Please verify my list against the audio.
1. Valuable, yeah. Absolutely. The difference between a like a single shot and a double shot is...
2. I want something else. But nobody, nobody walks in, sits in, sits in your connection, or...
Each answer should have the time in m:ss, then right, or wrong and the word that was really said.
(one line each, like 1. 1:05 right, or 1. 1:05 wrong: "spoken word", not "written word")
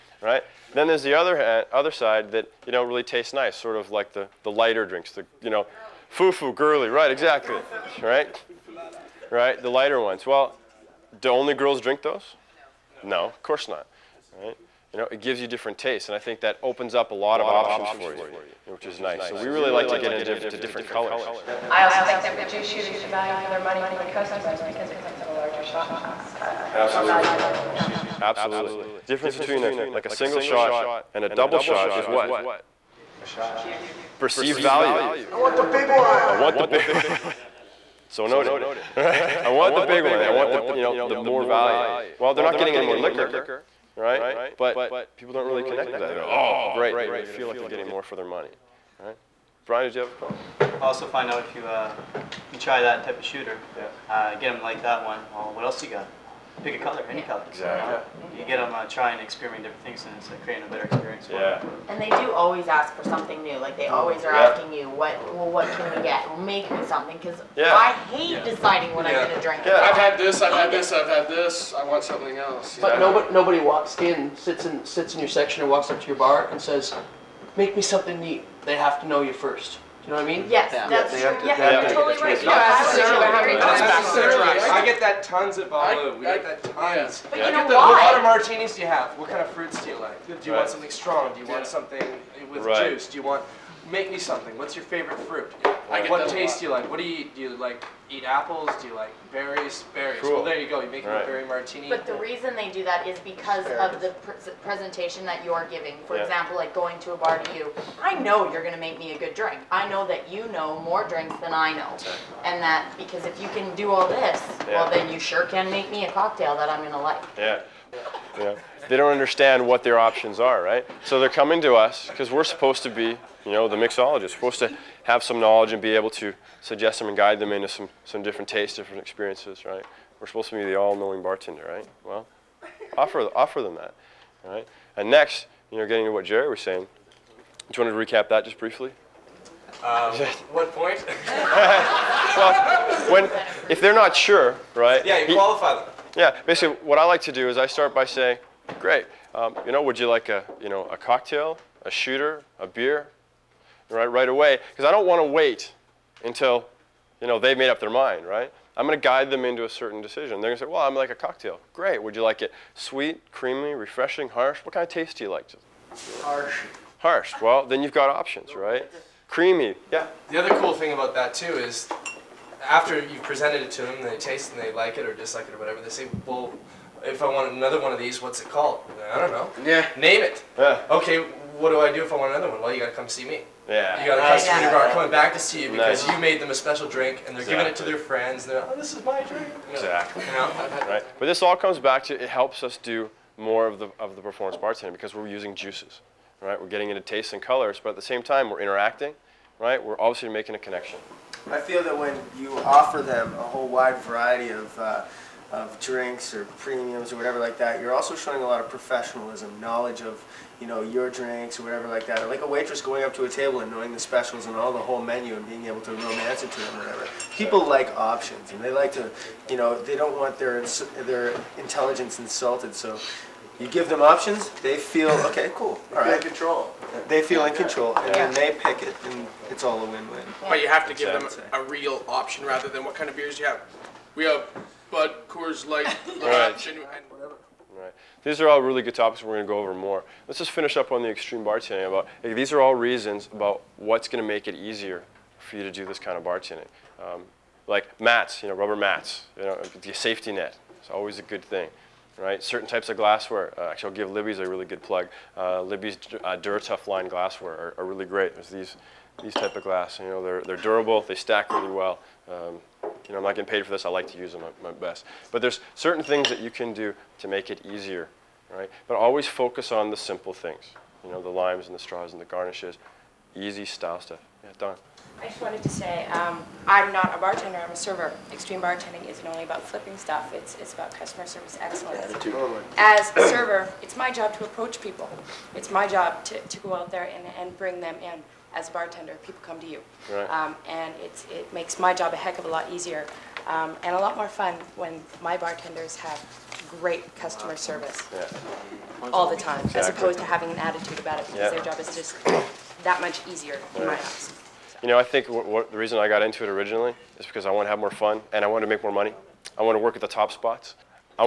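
1. 0:27 right
2. 1:11 wrong: "section", not "connection".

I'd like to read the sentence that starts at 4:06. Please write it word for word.
Um, like mats, you know, rubber mats, you know, the safety net.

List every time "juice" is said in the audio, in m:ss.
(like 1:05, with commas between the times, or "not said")
0:22, 1:32, 3:15.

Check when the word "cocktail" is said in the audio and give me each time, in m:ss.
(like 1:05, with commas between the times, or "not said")
1:56, 2:30, 2:41.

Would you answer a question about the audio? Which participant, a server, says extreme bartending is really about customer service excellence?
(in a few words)
Don.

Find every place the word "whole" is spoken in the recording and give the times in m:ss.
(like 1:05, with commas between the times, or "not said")
3:23, 3:34.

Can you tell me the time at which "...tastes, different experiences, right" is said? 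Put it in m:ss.
2:08.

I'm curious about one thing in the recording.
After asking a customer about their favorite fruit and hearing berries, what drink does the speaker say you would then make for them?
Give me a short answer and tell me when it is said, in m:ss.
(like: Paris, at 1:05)
berry martini, at 1:41.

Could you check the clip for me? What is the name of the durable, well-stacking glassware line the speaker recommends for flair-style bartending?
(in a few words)
Duratuff.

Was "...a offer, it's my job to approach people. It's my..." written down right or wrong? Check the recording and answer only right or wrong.
wrong.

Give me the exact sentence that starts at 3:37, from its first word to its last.
People like options and they like to, you know, they don't want their, their intelligence insulted.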